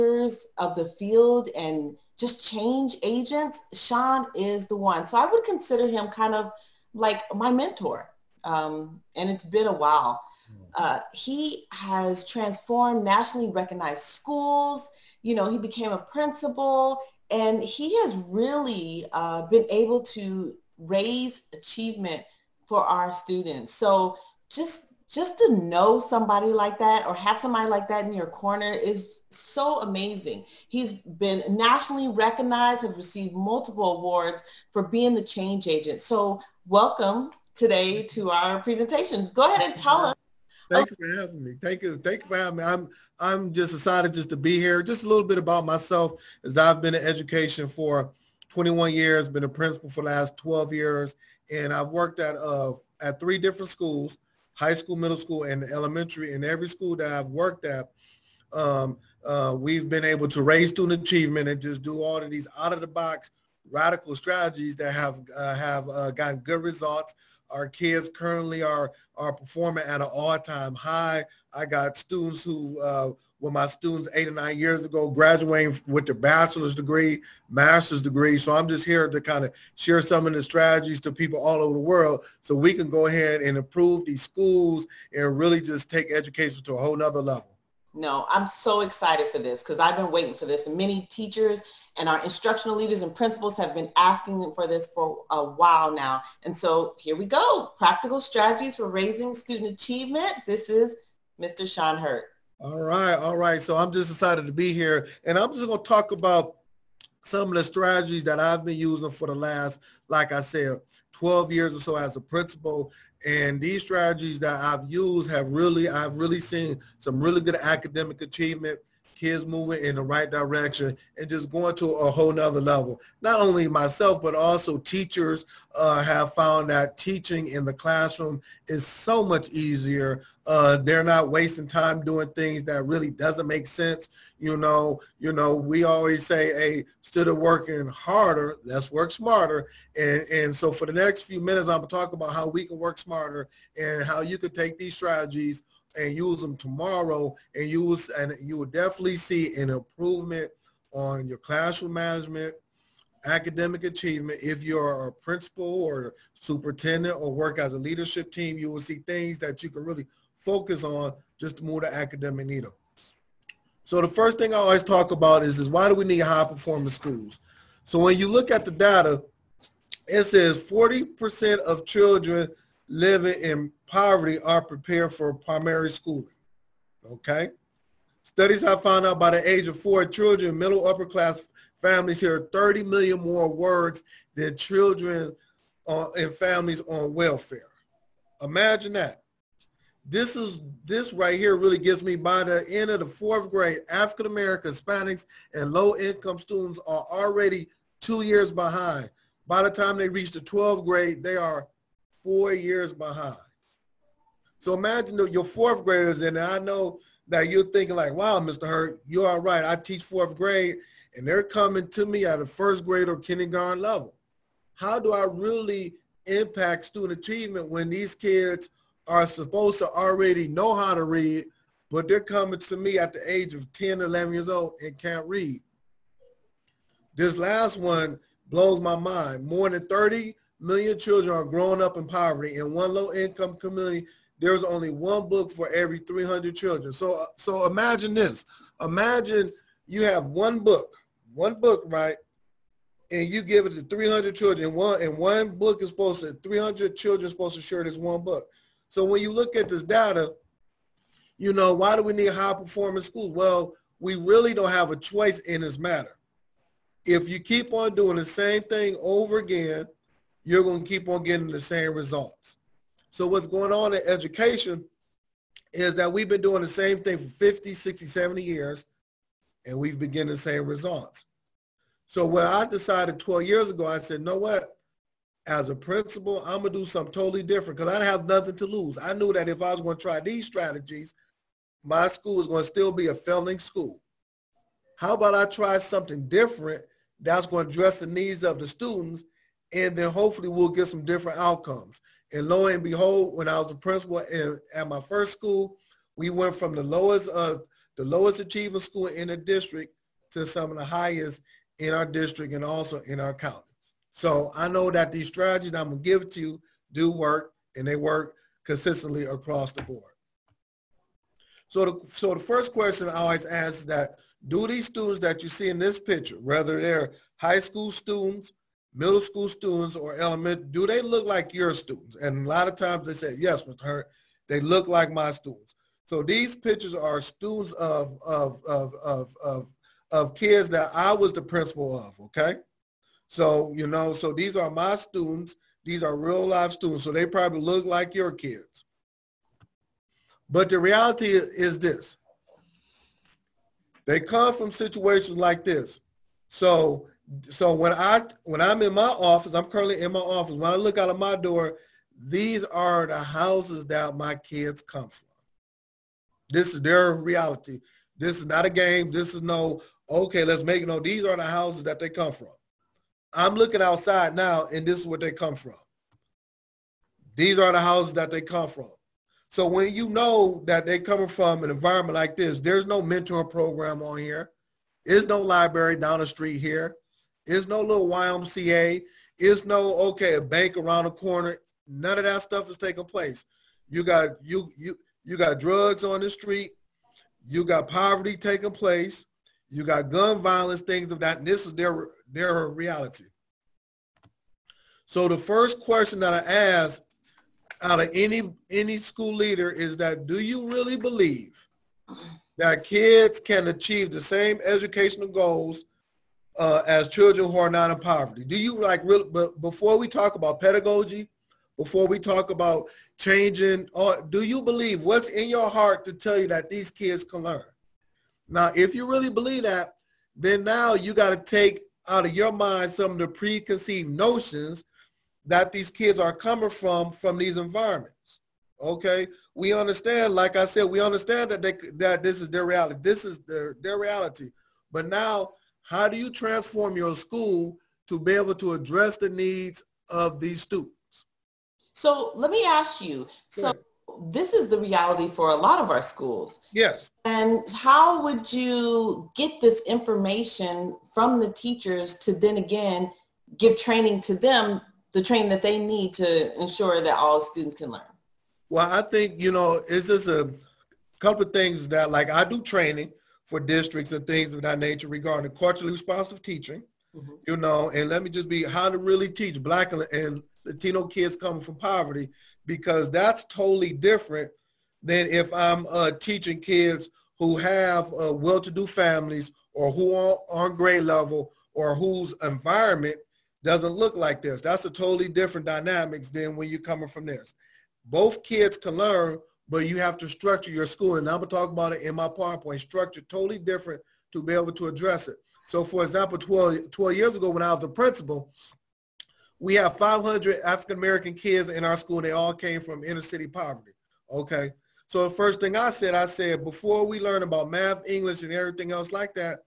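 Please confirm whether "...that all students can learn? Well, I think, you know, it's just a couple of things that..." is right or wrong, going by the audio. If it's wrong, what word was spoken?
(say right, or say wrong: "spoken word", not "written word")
right.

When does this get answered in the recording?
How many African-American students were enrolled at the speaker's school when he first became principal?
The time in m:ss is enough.
8:19.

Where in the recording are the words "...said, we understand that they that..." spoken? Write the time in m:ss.
7:10.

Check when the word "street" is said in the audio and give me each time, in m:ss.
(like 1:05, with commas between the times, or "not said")
6:16, 6:26.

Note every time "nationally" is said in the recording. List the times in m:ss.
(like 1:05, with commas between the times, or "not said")
0:13, 0:31.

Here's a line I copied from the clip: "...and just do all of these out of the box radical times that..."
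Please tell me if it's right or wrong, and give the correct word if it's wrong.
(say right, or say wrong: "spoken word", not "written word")
wrong: "strategies", not "times".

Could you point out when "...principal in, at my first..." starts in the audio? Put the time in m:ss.
4:53.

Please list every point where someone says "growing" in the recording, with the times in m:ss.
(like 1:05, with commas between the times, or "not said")
3:51.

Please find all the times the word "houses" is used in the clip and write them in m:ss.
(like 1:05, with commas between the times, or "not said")
5:53, 6:01, 6:07.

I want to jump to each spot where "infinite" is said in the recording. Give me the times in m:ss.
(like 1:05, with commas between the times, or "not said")
not said.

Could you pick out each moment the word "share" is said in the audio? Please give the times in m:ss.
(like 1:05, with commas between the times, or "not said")
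1:19, 4:07.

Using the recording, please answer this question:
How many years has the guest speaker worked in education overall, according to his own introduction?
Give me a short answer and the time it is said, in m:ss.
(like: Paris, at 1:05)
21, at 0:48.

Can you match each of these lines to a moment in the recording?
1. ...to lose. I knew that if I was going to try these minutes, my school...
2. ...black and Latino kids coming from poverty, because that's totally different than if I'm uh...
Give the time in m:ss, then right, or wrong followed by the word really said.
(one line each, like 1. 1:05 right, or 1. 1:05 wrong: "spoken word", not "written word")
1. 4:38 wrong: "strategies", not "minutes"
2. 7:49 right.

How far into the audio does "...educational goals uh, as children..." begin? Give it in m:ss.
6:44.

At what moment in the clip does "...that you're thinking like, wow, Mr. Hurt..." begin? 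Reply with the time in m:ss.
3:27.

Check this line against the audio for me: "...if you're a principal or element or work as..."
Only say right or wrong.
wrong.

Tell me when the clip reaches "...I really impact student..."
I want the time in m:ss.
3:35.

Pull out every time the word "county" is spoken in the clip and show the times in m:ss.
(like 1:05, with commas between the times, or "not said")
5:03.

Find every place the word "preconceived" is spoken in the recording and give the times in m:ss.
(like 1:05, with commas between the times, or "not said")
7:03.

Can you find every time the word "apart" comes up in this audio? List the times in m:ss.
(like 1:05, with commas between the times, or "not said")
not said.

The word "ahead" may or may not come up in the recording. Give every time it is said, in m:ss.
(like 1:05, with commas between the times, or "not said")
0:39, 1:23.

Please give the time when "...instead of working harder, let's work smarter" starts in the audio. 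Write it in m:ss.
2:17.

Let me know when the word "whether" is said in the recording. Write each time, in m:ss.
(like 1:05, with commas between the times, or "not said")
5:16.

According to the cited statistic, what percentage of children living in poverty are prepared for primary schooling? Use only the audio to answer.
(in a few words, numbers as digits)
40%.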